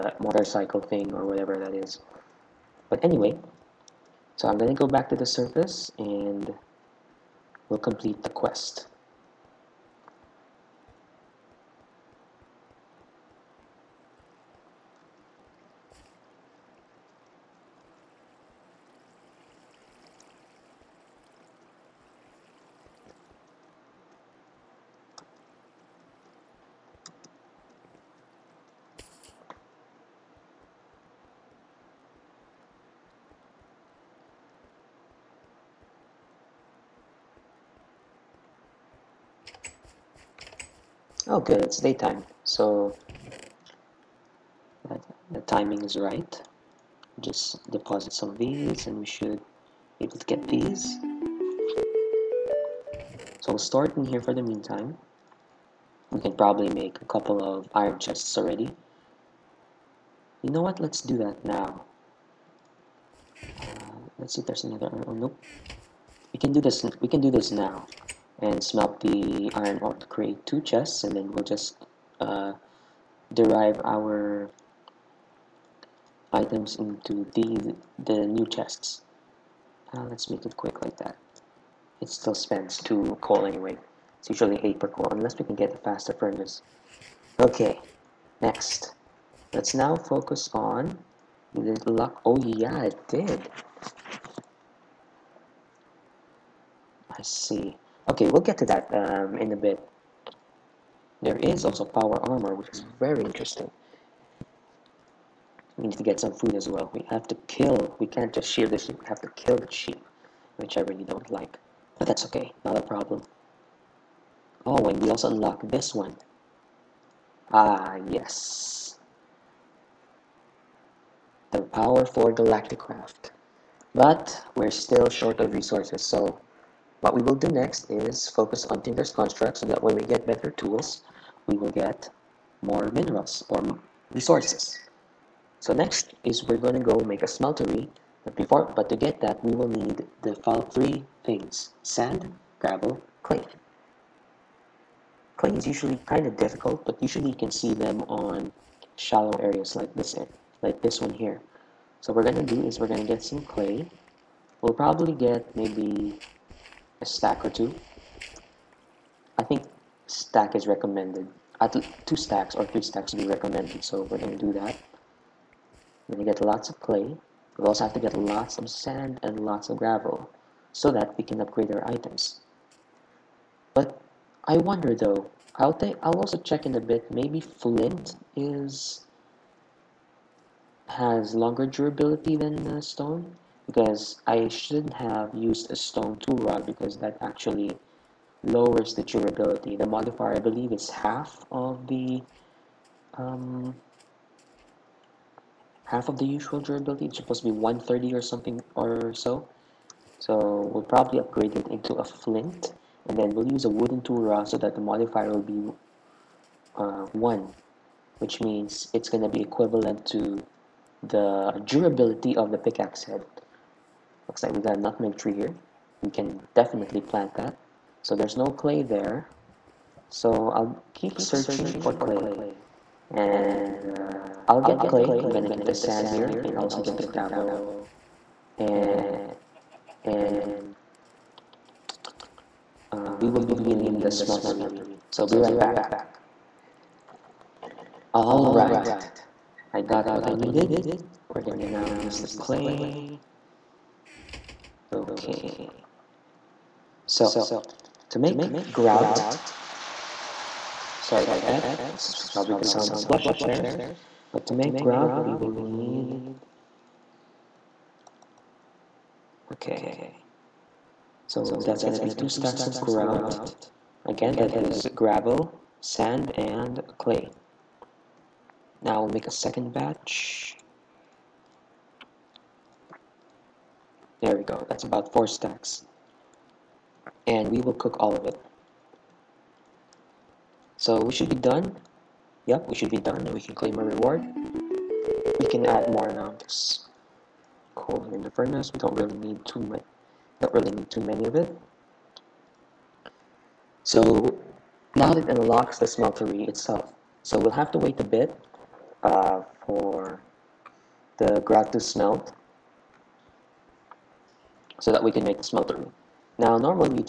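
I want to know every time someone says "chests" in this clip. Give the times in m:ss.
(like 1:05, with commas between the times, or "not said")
0:57, 1:10, 1:18.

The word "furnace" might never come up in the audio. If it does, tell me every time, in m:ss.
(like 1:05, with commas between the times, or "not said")
1:26, 4:48.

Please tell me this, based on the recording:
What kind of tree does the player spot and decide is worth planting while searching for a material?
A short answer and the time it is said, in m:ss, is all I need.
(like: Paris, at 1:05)
Nutmeg tree, at 3:34.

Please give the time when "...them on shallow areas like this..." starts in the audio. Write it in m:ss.
2:27.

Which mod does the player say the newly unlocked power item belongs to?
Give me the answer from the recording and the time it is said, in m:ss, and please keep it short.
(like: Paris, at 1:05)
Galacticraft, at 2:02.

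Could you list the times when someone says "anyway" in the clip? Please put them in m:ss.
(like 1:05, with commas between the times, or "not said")
0:03, 1:23.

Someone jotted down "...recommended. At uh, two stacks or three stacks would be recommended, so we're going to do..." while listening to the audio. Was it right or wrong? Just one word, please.
right.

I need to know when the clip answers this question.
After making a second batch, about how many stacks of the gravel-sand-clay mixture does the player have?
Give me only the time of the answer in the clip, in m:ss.
4:35.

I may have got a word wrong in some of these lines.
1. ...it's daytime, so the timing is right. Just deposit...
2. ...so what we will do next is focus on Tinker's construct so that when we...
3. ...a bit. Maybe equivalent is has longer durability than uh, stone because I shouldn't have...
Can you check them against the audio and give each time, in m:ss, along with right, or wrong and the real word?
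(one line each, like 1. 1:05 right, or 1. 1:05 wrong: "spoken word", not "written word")
1. 0:41 right
2. 2:06 right
3. 2:56 wrong: "flint", not "equivalent".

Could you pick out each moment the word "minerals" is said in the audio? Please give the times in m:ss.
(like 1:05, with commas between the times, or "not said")
2:12.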